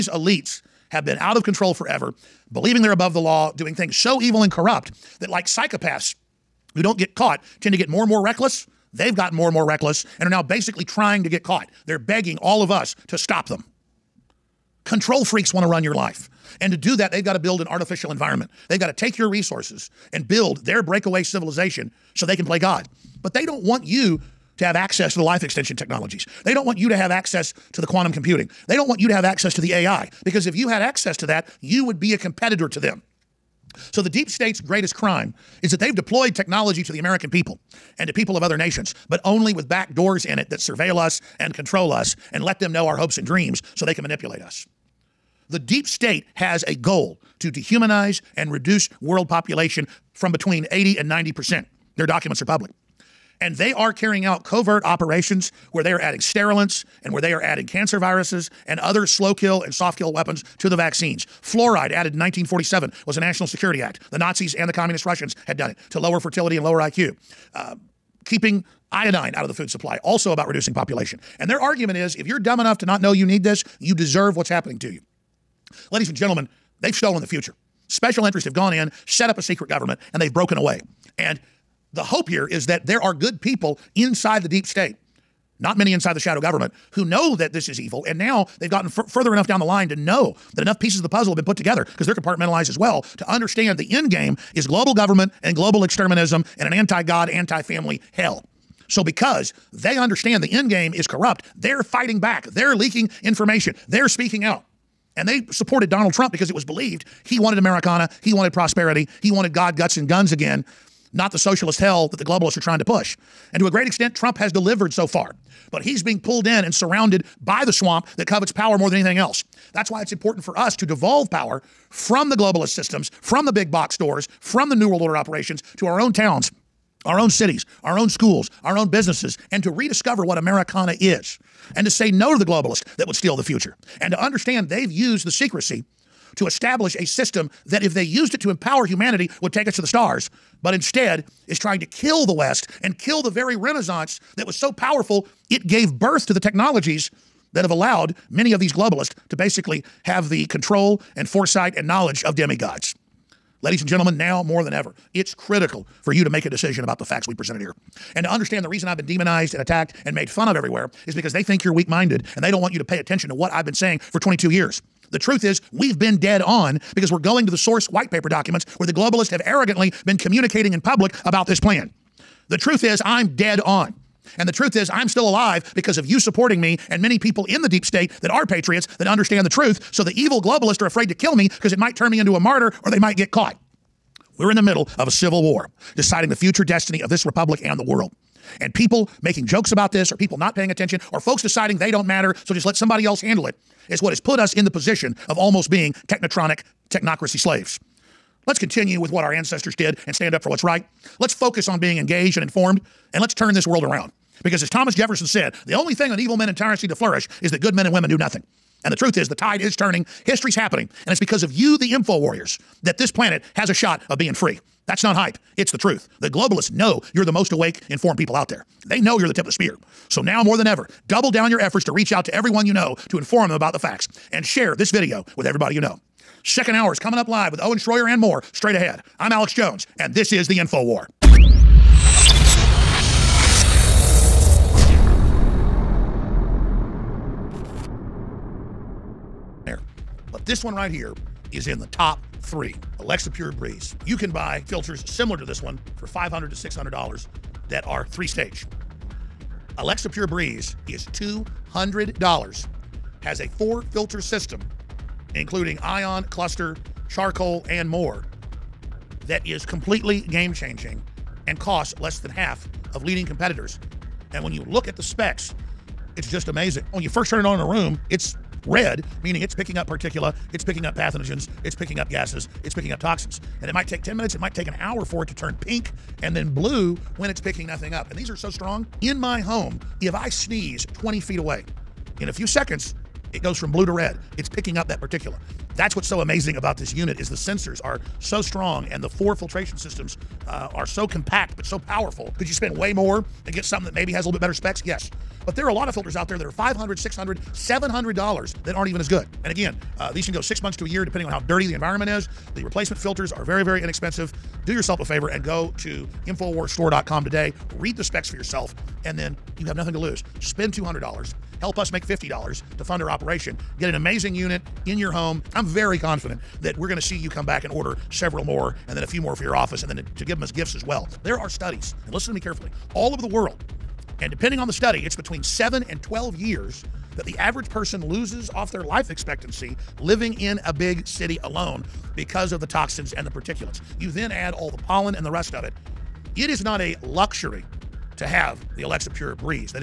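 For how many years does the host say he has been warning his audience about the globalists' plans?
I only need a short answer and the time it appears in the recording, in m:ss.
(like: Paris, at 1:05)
22 years, at 2:44.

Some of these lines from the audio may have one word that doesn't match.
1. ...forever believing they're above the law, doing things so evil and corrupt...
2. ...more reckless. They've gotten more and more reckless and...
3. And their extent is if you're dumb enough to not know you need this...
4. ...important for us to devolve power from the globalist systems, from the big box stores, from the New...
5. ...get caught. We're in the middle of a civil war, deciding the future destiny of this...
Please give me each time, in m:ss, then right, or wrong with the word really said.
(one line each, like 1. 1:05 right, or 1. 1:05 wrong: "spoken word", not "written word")
1. 0:01 right
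2. 0:08 right
3. 1:11 wrong: "argument", not "extent"
4. 2:00 right
5. 3:03 right.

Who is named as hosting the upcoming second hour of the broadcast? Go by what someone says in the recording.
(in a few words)
Owen Schroyer.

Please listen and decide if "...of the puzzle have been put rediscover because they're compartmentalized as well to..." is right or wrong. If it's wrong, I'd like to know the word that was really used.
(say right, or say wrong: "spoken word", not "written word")
wrong: "together", not "rediscover".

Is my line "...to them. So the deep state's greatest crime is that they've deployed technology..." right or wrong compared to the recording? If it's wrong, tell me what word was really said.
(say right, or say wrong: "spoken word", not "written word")
right.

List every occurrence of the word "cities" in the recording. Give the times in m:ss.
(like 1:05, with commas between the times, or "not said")
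2:07.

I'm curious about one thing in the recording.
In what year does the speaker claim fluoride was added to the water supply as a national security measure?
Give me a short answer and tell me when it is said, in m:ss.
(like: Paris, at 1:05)
1947, at 1:02.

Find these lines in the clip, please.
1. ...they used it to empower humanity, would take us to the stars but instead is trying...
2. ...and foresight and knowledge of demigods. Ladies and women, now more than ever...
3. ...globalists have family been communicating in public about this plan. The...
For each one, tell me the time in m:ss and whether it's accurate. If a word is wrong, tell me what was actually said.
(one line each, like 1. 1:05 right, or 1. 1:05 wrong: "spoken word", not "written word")
1. 2:17 right
2. 2:31 wrong: "gentlemen", not "women"
3. 2:48 wrong: "arrogantly", not "family".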